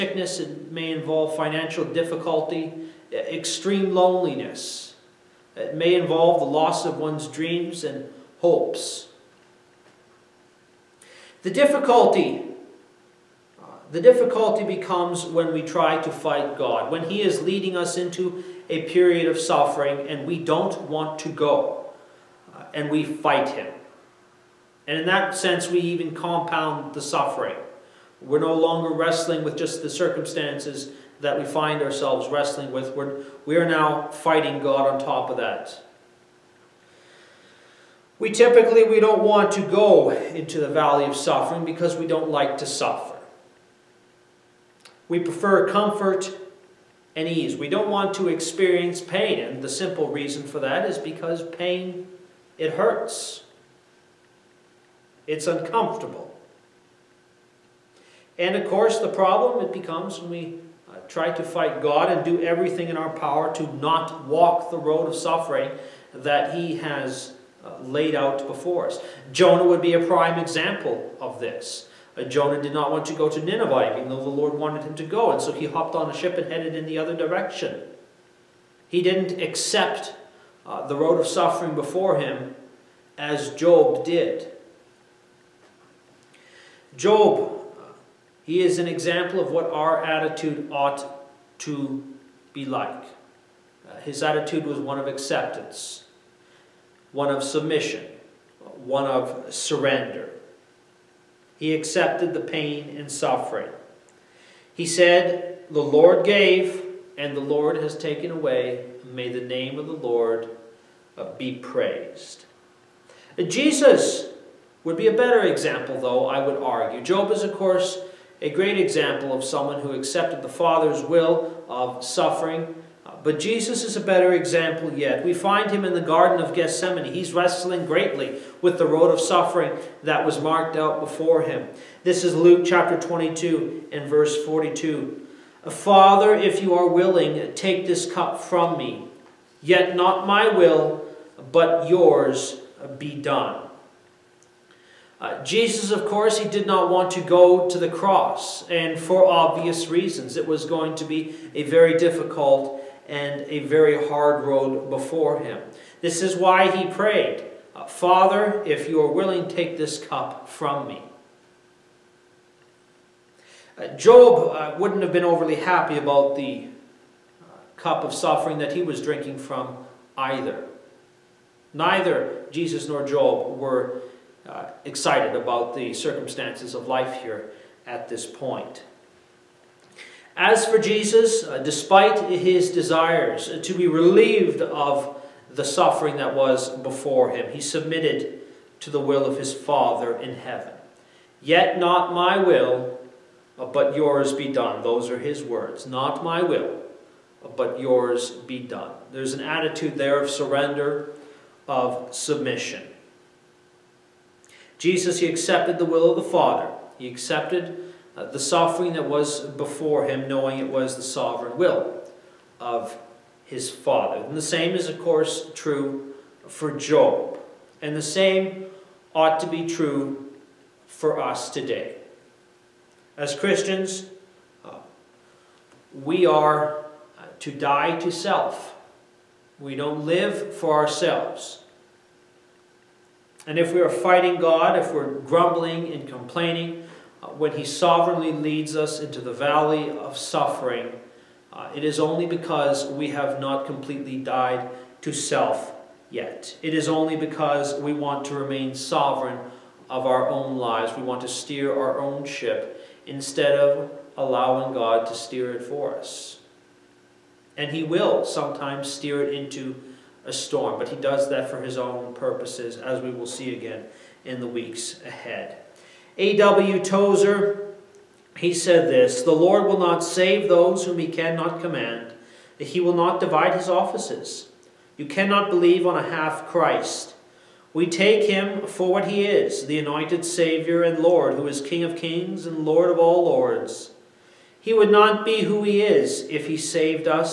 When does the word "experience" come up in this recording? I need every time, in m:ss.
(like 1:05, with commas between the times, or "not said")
0:48.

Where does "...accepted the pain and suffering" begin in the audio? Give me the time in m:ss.
1:41.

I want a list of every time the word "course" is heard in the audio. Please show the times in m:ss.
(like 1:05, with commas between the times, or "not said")
0:58, 1:57, 2:26, 3:34.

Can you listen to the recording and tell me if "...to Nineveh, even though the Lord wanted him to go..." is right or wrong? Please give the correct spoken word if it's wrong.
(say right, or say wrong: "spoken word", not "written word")
right.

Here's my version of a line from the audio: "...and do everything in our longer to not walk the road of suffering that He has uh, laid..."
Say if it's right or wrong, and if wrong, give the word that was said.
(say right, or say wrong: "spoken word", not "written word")
wrong: "power", not "longer".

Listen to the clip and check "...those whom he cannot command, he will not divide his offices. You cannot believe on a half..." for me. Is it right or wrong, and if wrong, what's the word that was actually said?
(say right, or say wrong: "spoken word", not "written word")
right.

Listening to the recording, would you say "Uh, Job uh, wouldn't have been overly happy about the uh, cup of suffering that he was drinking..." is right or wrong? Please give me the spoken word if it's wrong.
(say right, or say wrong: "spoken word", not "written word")
right.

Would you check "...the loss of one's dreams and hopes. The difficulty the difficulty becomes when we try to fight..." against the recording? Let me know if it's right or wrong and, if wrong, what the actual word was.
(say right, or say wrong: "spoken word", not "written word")
right.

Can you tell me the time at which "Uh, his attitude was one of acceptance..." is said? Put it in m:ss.
1:33.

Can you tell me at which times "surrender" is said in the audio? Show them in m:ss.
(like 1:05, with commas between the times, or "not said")
1:39, 3:20.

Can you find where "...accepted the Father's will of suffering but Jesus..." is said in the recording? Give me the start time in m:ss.
1:59.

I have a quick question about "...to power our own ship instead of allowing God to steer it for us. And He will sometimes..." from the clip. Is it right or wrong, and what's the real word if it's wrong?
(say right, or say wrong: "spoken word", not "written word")
wrong: "steer", not "power".